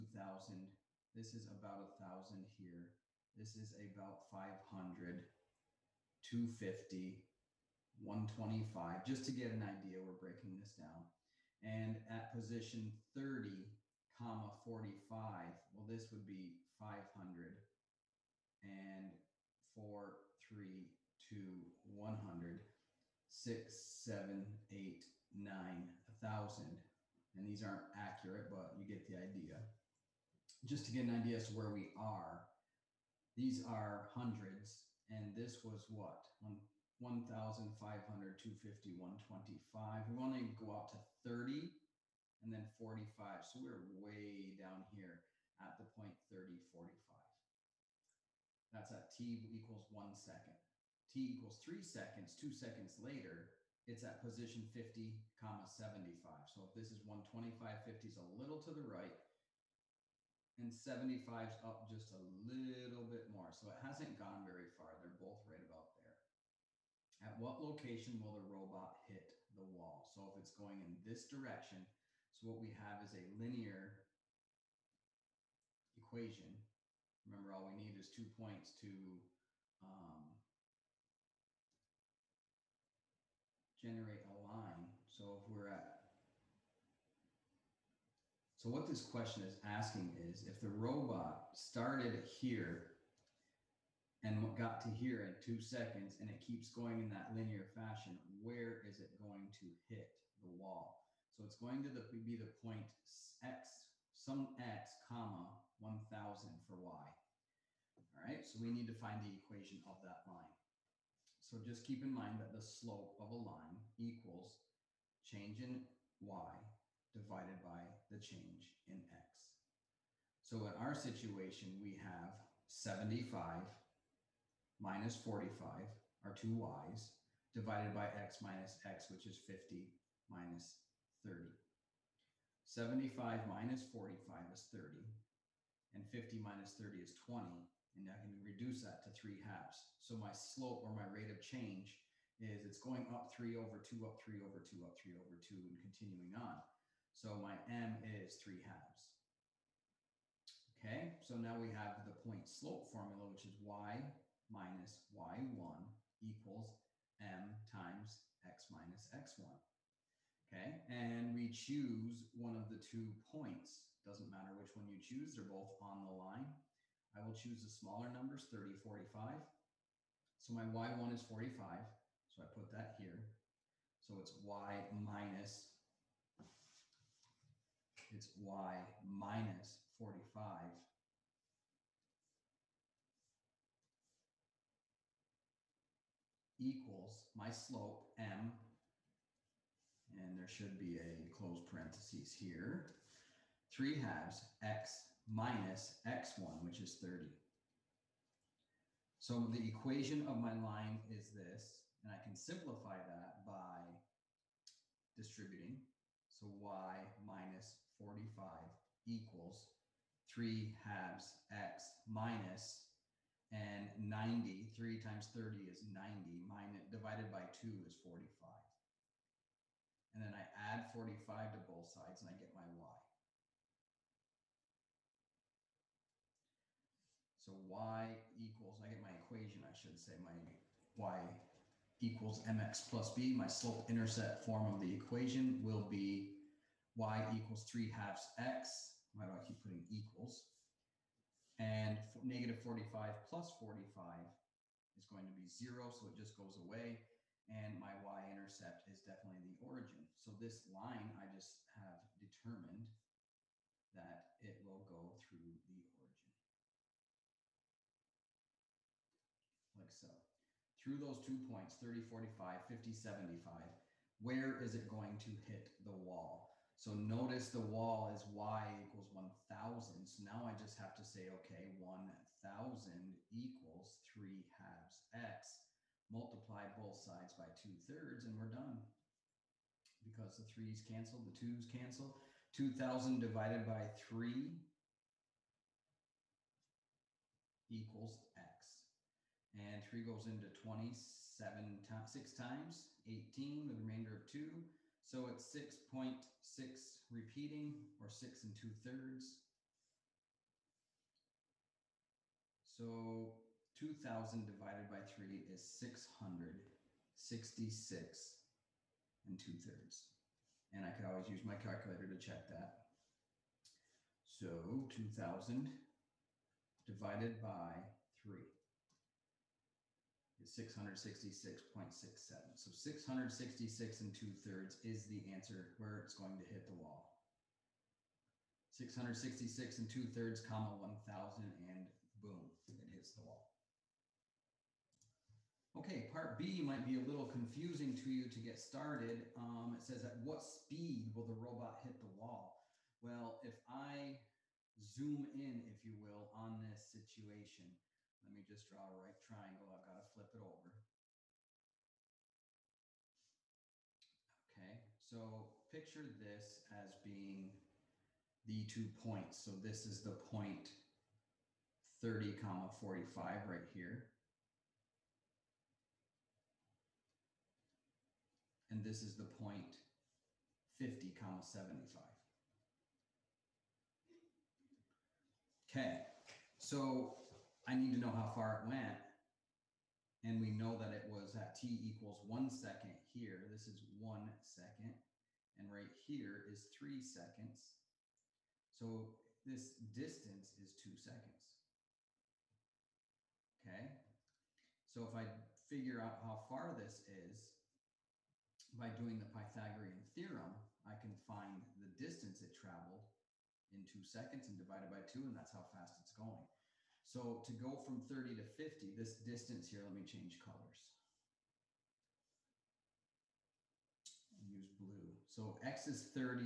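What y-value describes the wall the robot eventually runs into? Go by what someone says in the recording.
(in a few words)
1000.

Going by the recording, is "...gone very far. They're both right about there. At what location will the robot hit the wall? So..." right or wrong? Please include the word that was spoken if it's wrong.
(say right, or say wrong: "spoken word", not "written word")
right.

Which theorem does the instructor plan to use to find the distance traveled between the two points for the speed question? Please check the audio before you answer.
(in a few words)
Pythagorean theorem.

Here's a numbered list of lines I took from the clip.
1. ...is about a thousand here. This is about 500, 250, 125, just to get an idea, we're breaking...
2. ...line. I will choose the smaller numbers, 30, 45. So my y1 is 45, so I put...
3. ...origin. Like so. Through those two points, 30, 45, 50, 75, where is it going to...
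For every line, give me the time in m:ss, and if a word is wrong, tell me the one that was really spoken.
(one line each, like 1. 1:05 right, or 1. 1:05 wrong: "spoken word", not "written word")
1. 0:01 right
2. 2:46 right
3. 4:15 right.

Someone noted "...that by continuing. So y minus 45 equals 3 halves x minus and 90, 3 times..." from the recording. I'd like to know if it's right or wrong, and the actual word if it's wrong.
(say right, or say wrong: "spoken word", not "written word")
wrong: "distributing", not "continuing".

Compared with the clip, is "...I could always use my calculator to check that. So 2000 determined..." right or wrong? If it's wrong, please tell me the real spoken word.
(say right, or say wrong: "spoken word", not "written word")
wrong: "divided", not "determined".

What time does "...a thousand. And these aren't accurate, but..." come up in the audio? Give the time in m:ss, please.
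0:25.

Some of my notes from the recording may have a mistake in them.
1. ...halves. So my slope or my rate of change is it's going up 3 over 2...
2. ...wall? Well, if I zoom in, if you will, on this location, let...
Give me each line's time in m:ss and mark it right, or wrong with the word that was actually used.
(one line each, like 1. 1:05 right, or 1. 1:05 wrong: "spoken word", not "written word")
1. 2:19 right
2. 5:42 wrong: "situation", not "location".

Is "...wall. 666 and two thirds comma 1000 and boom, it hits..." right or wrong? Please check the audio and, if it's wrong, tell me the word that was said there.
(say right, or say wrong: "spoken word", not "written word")
right.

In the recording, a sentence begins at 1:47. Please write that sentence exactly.
All right, so we need to find the equation of that line.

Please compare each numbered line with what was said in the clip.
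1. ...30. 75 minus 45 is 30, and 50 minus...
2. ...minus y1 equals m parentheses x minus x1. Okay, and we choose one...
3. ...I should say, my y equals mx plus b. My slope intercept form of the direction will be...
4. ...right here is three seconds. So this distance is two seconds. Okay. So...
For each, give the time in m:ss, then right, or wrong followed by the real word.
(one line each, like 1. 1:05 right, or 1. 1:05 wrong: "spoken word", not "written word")
1. 2:11 right
2. 2:34 wrong: "times", not "parentheses"
3. 3:49 wrong: "equation", not "direction"
4. 6:25 right.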